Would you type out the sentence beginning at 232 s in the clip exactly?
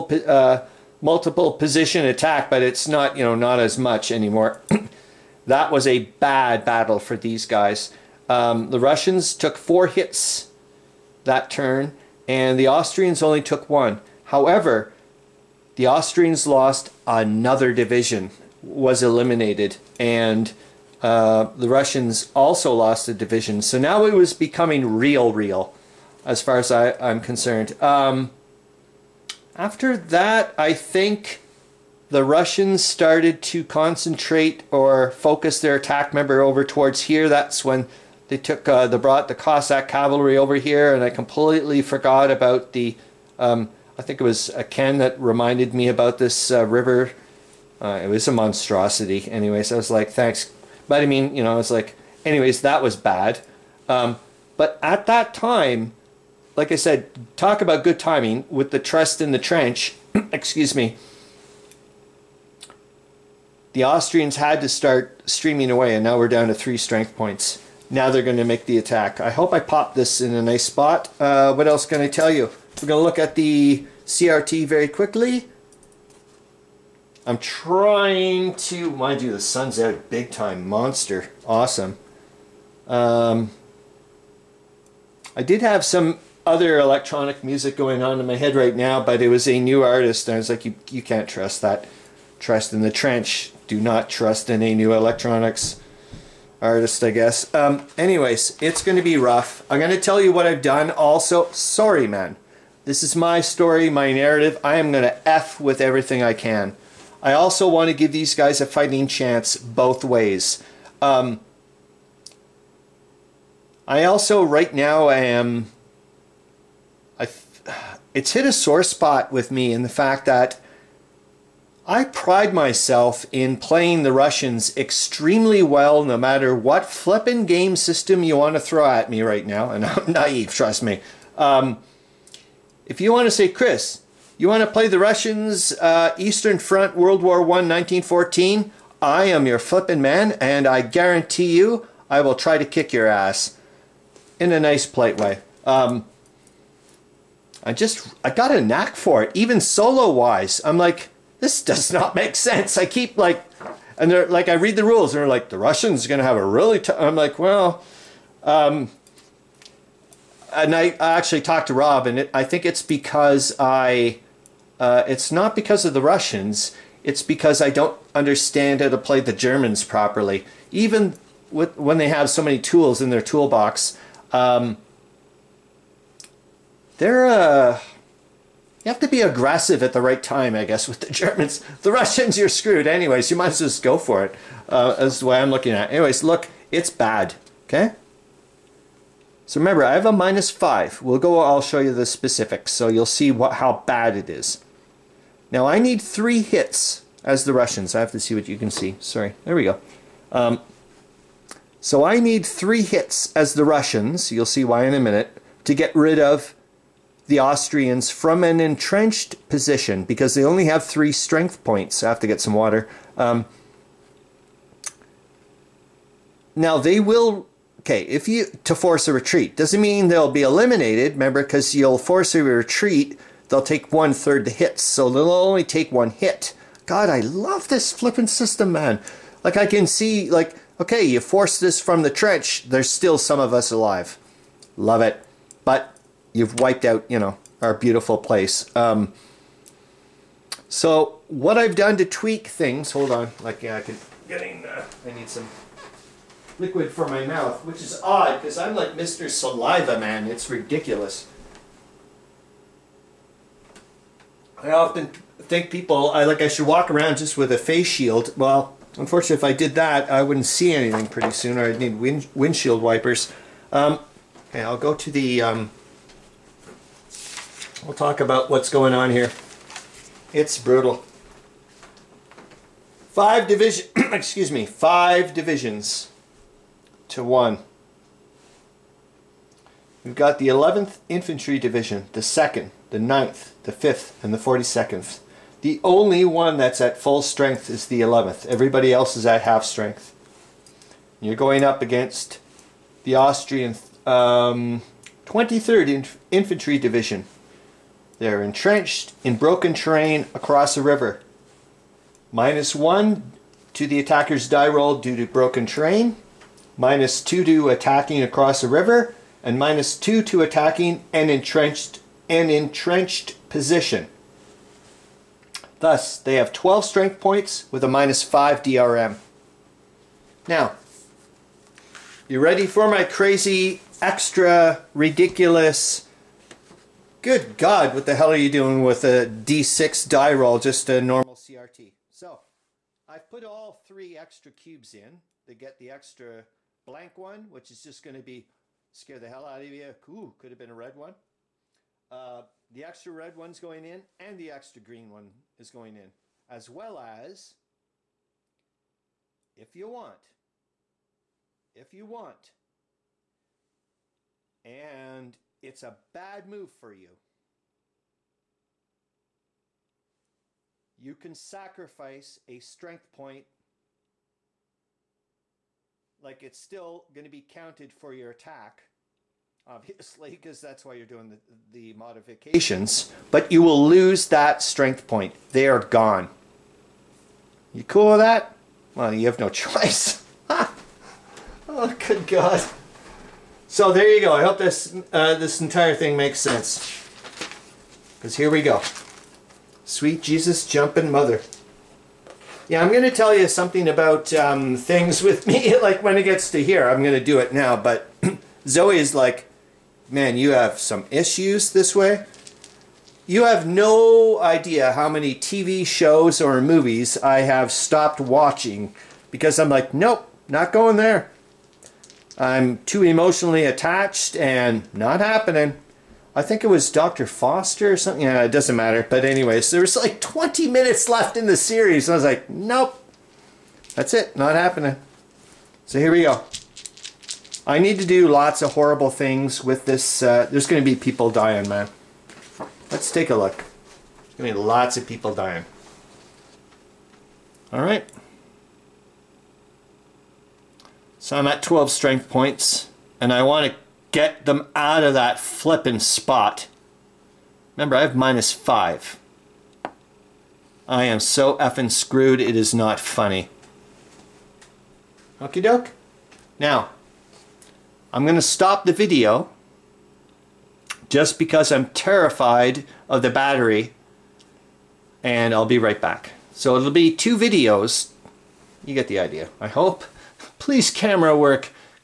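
There's still some of us alive.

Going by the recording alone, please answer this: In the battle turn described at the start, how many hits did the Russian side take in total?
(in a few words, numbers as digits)
4.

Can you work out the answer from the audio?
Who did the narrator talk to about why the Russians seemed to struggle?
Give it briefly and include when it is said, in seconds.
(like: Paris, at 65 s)
Rob, at 161 s.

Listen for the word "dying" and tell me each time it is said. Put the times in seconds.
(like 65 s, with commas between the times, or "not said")
431 s, 435 s.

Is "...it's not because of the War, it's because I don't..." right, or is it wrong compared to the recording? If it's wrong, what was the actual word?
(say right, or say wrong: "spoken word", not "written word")
wrong: "Russians", not "War".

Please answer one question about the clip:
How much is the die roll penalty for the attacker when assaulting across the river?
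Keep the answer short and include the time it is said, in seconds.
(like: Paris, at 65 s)
-2, at 306 s.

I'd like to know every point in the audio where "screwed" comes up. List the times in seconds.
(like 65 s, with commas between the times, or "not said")
182 s, 451 s.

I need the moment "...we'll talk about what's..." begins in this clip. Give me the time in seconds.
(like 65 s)
267 s.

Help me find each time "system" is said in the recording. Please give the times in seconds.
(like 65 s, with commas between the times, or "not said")
127 s, 228 s.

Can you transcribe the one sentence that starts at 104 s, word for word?
I am going to F with everything I can.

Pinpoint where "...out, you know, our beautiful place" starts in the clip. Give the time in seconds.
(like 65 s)
236 s.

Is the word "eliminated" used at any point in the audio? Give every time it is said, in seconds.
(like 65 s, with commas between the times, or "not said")
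19 s, 220 s.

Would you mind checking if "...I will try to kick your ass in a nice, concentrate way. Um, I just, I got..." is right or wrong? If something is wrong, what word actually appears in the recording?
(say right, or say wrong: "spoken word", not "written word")
wrong: "polite", not "concentrate".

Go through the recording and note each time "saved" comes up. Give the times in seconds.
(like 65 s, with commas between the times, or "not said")
not said.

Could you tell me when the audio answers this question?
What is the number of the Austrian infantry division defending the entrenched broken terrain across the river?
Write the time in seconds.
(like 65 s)
295 s.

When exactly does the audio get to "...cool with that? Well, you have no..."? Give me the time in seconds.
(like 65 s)
377 s.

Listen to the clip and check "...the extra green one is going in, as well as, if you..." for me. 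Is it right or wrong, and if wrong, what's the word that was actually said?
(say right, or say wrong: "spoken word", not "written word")
right.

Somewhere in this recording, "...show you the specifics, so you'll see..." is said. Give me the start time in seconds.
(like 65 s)
191 s.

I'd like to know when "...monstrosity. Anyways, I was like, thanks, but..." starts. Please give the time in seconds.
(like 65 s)
48 s.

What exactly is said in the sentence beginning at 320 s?
Now, you ready for my crazy, extra, ridiculous...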